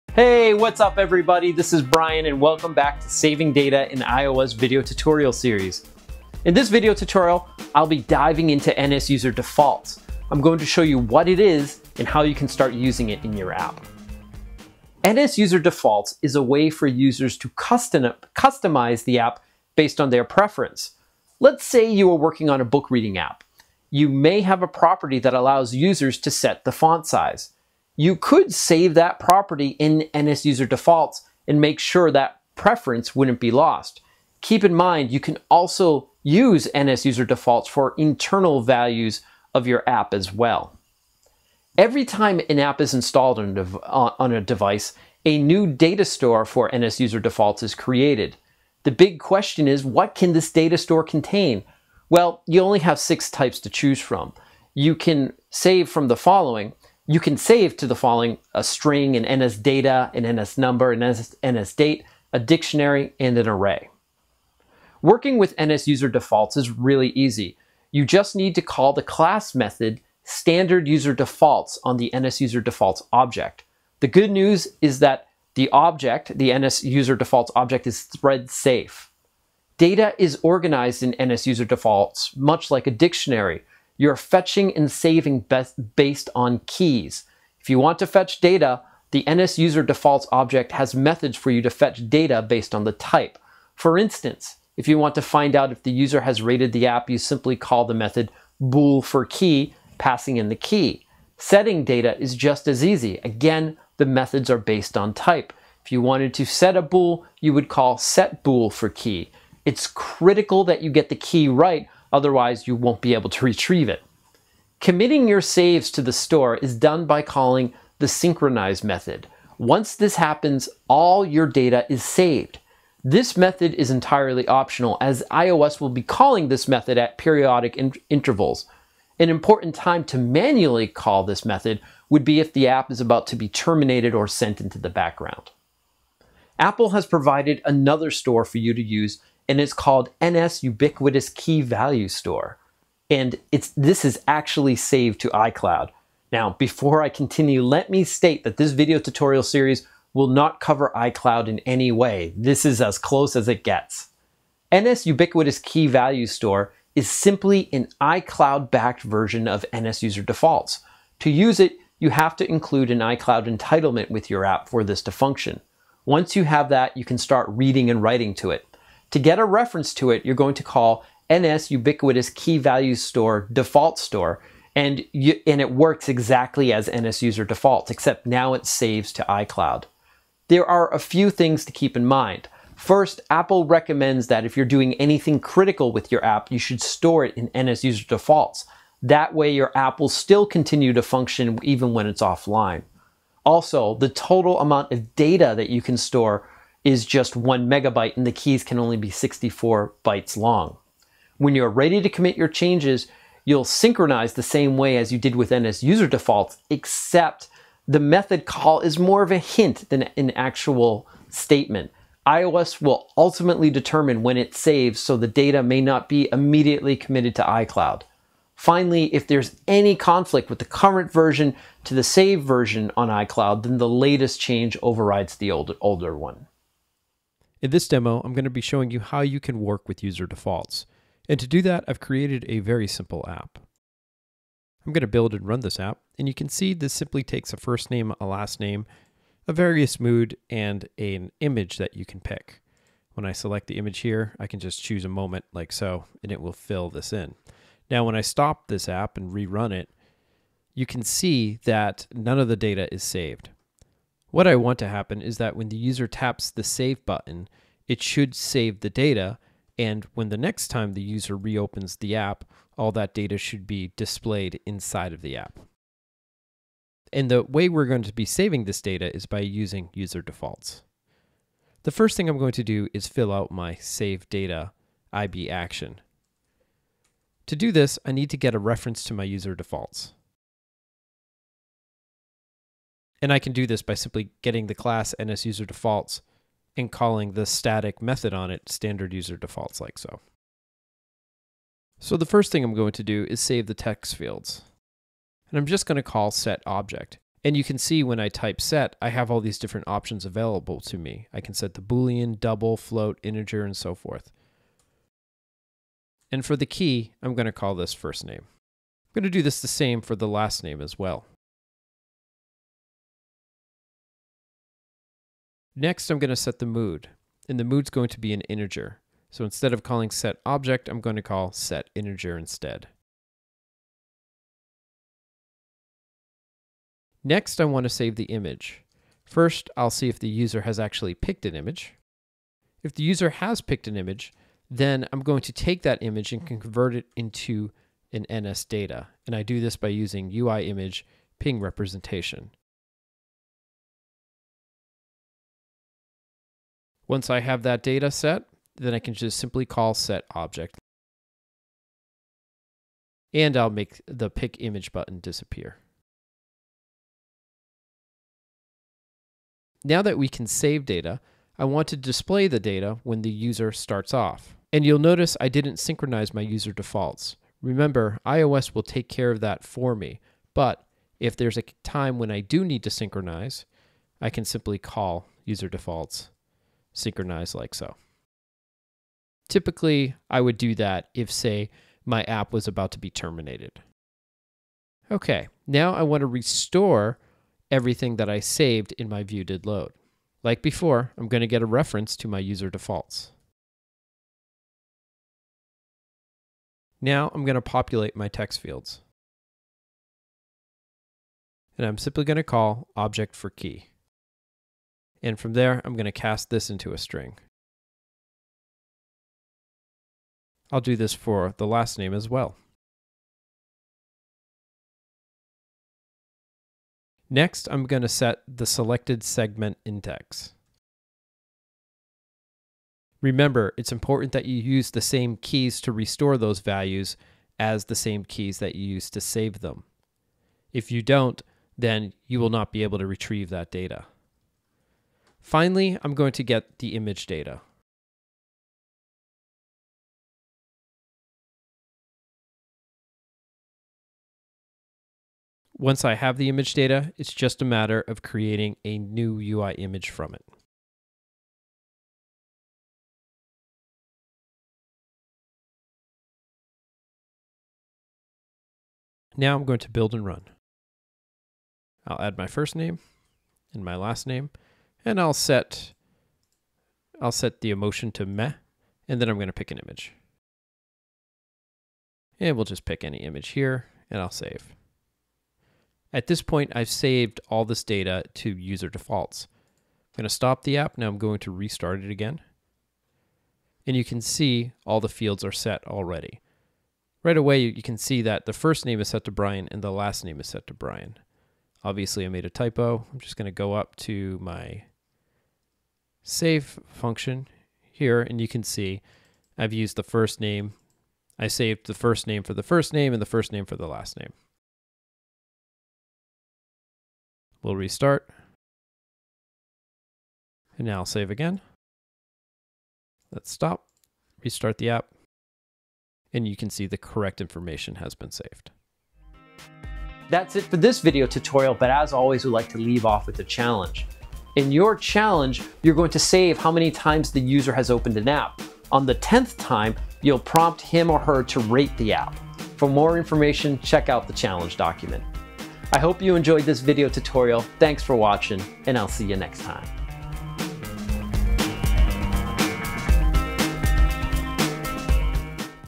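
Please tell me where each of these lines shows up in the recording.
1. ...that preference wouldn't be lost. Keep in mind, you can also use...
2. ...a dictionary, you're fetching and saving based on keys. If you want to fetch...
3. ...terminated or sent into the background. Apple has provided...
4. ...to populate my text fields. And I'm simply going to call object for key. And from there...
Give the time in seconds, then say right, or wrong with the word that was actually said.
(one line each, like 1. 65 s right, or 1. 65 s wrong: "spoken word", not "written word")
1. 32 s right
2. 82 s right
3. 133 s right
4. 397 s right.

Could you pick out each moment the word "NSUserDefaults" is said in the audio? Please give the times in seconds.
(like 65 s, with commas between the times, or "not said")
89 s, 285 s.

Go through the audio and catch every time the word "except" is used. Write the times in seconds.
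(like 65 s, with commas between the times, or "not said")
177 s, 206 s.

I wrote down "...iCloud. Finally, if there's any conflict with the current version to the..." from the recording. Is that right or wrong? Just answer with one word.
right.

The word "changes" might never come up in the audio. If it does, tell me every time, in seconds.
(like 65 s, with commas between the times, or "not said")
202 s, 224 s.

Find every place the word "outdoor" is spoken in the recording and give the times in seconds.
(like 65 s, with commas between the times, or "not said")
not said.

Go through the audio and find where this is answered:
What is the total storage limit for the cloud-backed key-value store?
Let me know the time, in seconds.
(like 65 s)
197 s.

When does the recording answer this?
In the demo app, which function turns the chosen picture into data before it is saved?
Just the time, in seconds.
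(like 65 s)
340 s.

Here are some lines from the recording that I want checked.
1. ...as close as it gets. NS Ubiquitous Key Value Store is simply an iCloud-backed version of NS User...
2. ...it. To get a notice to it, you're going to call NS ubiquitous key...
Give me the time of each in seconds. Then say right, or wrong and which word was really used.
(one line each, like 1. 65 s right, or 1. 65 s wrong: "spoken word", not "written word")
1. 152 s right
2. 168 s wrong: "reference", not "notice".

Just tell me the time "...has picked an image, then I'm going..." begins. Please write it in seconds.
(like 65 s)
333 s.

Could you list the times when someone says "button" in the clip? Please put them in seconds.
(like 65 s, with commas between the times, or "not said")
257 s, 354 s.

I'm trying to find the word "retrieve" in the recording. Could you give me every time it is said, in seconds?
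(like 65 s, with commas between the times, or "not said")
113 s, 433 s.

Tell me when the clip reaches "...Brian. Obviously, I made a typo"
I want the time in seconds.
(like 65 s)
490 s.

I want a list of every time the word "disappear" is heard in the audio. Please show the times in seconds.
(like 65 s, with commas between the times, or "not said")
355 s.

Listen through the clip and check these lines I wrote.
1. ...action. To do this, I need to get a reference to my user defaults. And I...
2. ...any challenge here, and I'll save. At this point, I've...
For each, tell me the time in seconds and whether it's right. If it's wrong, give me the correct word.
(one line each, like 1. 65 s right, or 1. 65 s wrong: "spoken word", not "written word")
1. 275 s right
2. 473 s wrong: "image", not "challenge".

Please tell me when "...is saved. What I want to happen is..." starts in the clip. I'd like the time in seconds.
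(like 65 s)
252 s.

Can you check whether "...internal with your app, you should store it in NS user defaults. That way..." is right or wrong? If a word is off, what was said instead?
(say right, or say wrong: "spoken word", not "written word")
wrong: "critical", not "internal".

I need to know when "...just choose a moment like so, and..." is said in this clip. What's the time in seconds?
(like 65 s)
244 s.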